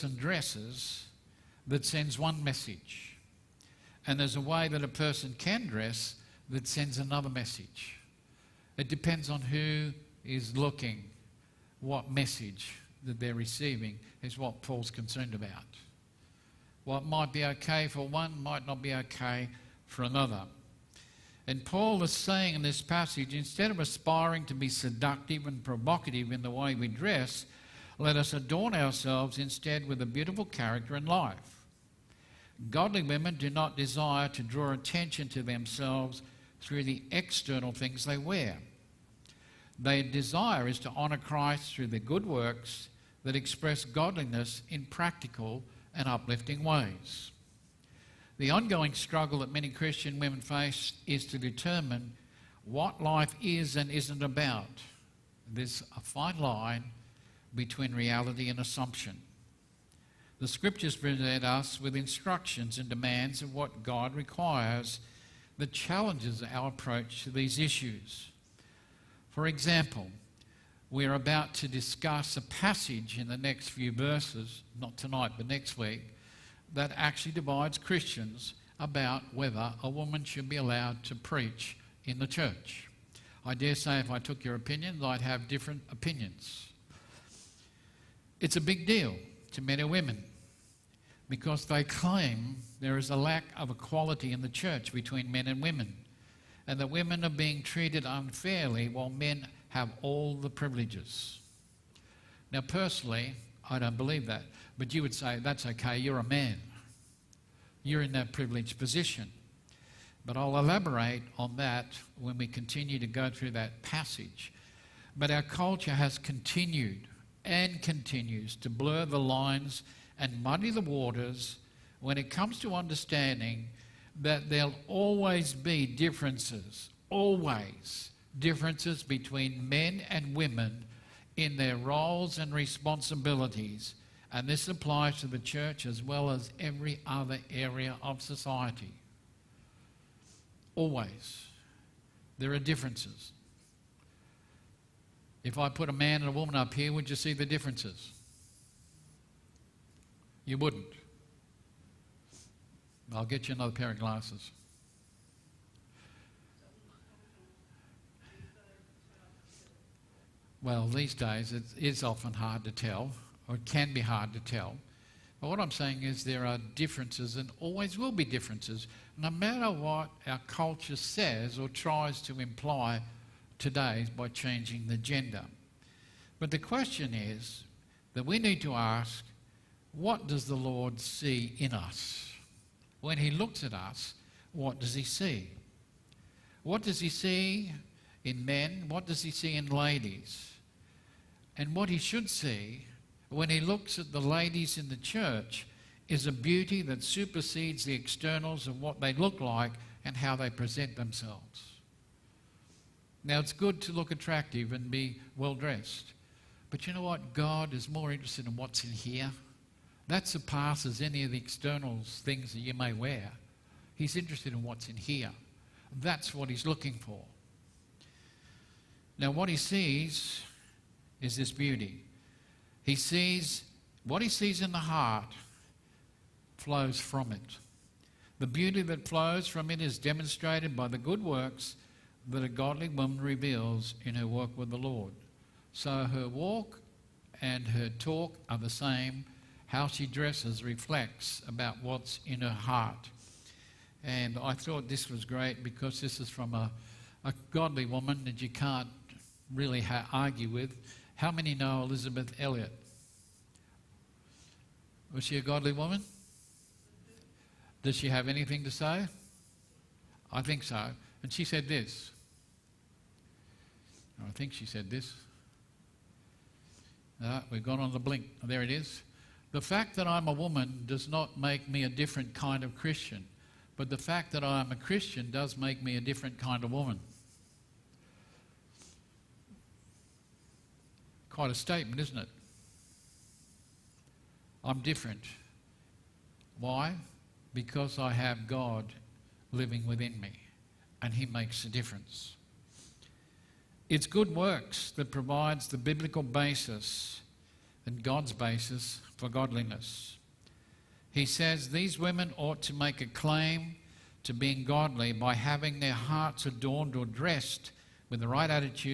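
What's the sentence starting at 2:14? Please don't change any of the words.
And this applies to the church as well as every other area of society.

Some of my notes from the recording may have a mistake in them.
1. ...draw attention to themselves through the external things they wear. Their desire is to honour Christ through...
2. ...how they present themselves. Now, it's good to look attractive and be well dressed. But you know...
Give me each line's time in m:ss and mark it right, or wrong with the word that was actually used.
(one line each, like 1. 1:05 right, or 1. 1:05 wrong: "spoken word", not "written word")
1. 0:34 right
2. 3:20 right.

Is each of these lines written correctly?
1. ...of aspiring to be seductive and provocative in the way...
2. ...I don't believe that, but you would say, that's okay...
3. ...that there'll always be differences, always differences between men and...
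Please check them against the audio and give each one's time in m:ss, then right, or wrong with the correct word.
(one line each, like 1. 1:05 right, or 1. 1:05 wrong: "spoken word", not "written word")
1. 0:23 right
2. 1:43 right
3. 2:04 right.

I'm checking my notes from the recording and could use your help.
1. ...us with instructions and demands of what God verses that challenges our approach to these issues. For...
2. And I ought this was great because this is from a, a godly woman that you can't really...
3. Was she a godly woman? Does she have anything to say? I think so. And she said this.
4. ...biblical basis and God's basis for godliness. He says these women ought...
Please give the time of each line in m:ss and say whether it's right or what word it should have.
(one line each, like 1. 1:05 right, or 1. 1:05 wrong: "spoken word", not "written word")
1. 1:01 wrong: "requires", not "verses"
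2. 4:04 wrong: "thought", not "ought"
3. 4:15 right
4. 4:55 right.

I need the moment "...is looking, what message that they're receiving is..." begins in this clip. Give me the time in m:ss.
0:10.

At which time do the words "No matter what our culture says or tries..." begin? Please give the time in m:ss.
2:49.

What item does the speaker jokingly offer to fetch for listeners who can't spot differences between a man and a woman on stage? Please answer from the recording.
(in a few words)
another pair of glasses.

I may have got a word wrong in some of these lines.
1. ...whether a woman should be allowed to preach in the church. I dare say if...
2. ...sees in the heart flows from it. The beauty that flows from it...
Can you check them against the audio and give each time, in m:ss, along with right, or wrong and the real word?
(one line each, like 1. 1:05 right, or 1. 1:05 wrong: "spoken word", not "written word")
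1. 1:19 right
2. 3:44 right.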